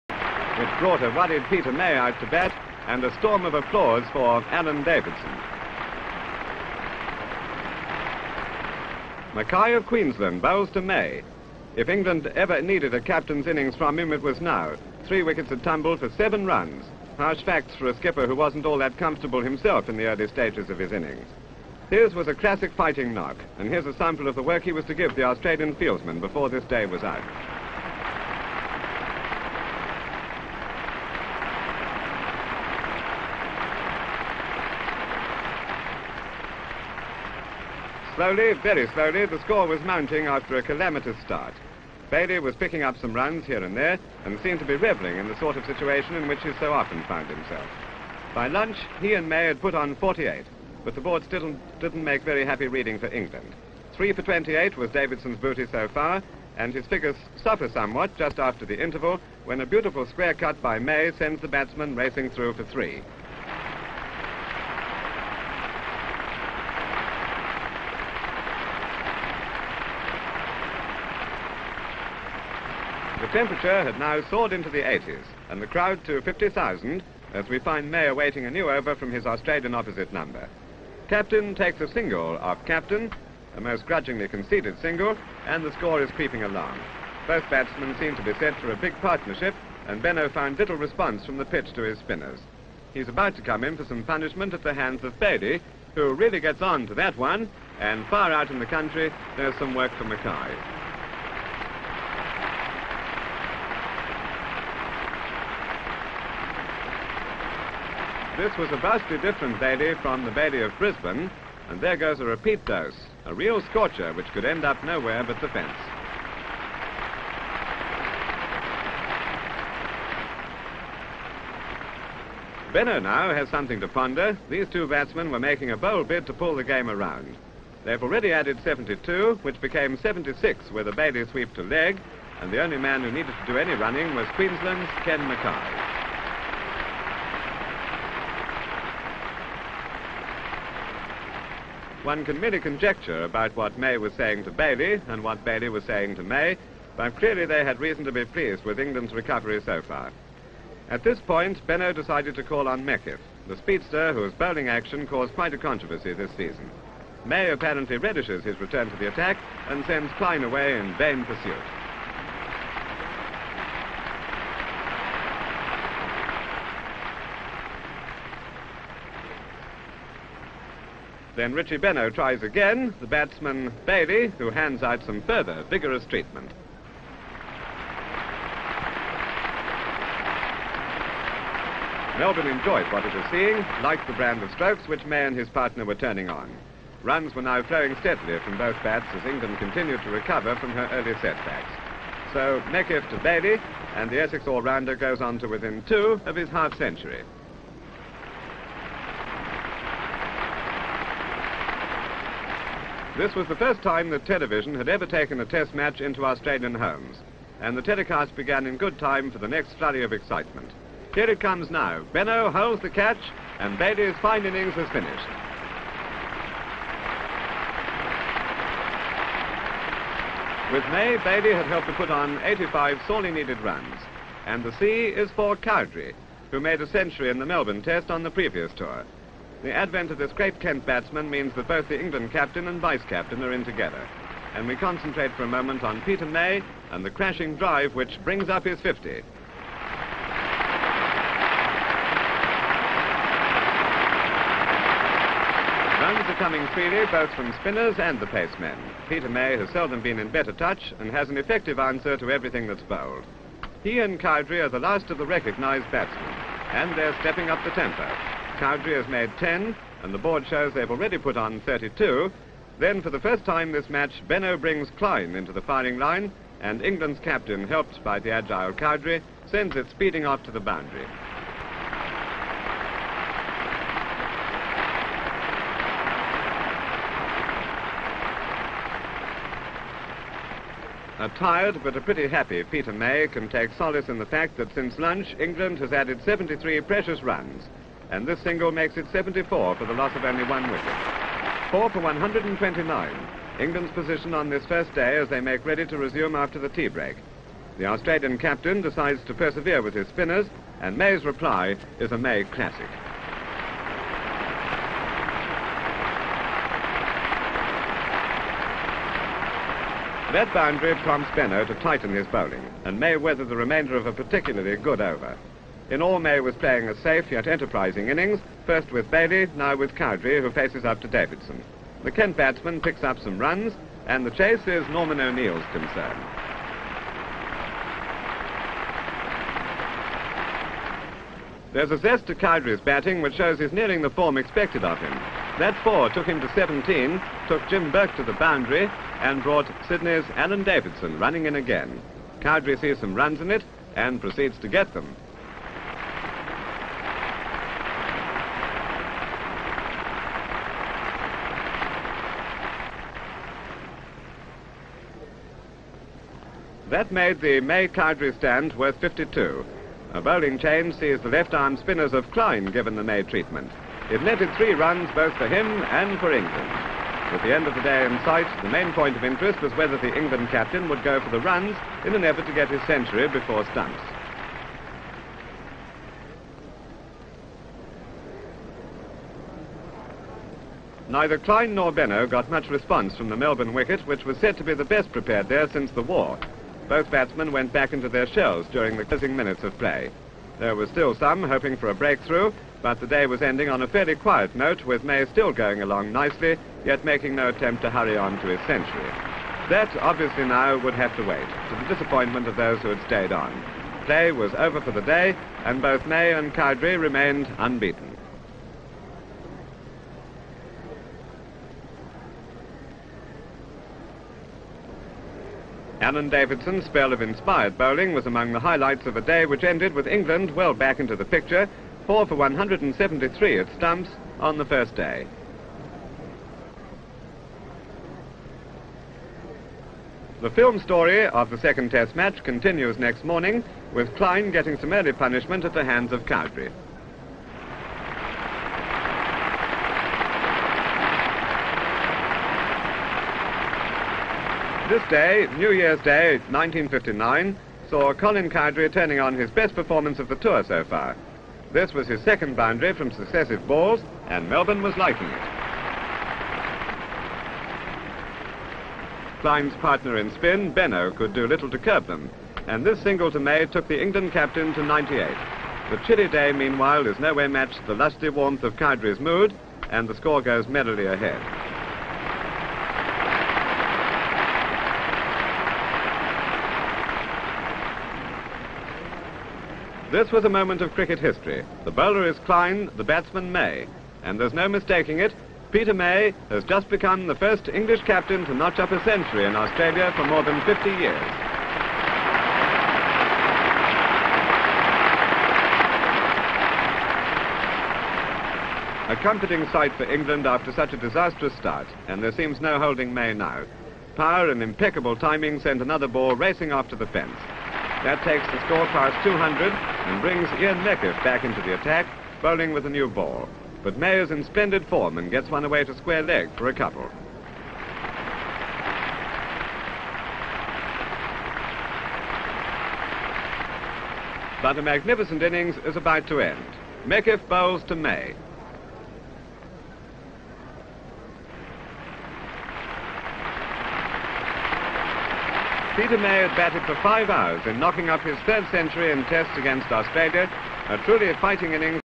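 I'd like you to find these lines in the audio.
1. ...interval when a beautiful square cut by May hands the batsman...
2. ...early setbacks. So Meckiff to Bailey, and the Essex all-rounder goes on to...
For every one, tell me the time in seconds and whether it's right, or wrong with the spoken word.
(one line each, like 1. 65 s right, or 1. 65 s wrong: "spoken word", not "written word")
1. 58 s wrong: "sends", not "hands"
2. 190 s right.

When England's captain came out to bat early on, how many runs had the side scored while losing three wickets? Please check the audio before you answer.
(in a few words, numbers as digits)
7.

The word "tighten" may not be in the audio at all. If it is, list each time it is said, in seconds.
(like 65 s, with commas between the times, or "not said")
311 s.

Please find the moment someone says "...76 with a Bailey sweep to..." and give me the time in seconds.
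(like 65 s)
129 s.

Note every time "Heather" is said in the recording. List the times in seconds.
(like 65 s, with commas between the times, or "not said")
not said.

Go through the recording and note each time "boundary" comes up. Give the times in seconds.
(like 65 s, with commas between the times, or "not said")
270 s, 310 s, 338 s, 452 s.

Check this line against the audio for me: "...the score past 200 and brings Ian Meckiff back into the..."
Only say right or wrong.
right.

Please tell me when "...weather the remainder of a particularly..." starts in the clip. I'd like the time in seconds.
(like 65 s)
313 s.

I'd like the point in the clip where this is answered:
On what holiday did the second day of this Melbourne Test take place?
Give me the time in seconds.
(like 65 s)
445 s.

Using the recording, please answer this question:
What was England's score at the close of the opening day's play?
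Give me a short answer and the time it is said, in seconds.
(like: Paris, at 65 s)
4 for 173, at 422 s.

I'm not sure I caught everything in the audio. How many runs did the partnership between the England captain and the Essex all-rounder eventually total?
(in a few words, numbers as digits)
85.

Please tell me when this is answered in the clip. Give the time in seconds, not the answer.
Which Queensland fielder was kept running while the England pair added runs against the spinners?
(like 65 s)
135 s.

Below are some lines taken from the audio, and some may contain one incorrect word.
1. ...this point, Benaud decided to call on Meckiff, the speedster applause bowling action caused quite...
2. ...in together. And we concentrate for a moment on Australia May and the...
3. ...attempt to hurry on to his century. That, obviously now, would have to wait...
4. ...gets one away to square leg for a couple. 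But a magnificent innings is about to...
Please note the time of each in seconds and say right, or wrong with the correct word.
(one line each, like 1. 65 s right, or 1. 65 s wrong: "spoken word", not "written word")
1. 151 s wrong: "whose", not "applause"
2. 233 s wrong: "Peter", not "Australia"
3. 397 s right
4. 515 s right.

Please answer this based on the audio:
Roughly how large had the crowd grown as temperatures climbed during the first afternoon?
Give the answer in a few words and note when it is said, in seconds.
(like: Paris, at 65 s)
50,000, at 76 s.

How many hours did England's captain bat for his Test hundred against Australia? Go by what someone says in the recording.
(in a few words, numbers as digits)
5.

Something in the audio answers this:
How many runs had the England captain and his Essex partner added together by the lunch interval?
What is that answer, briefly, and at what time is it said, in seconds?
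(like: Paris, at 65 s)
48, at 49 s.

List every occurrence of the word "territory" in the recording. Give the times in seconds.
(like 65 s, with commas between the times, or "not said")
not said.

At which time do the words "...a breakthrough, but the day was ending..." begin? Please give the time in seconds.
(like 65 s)
391 s.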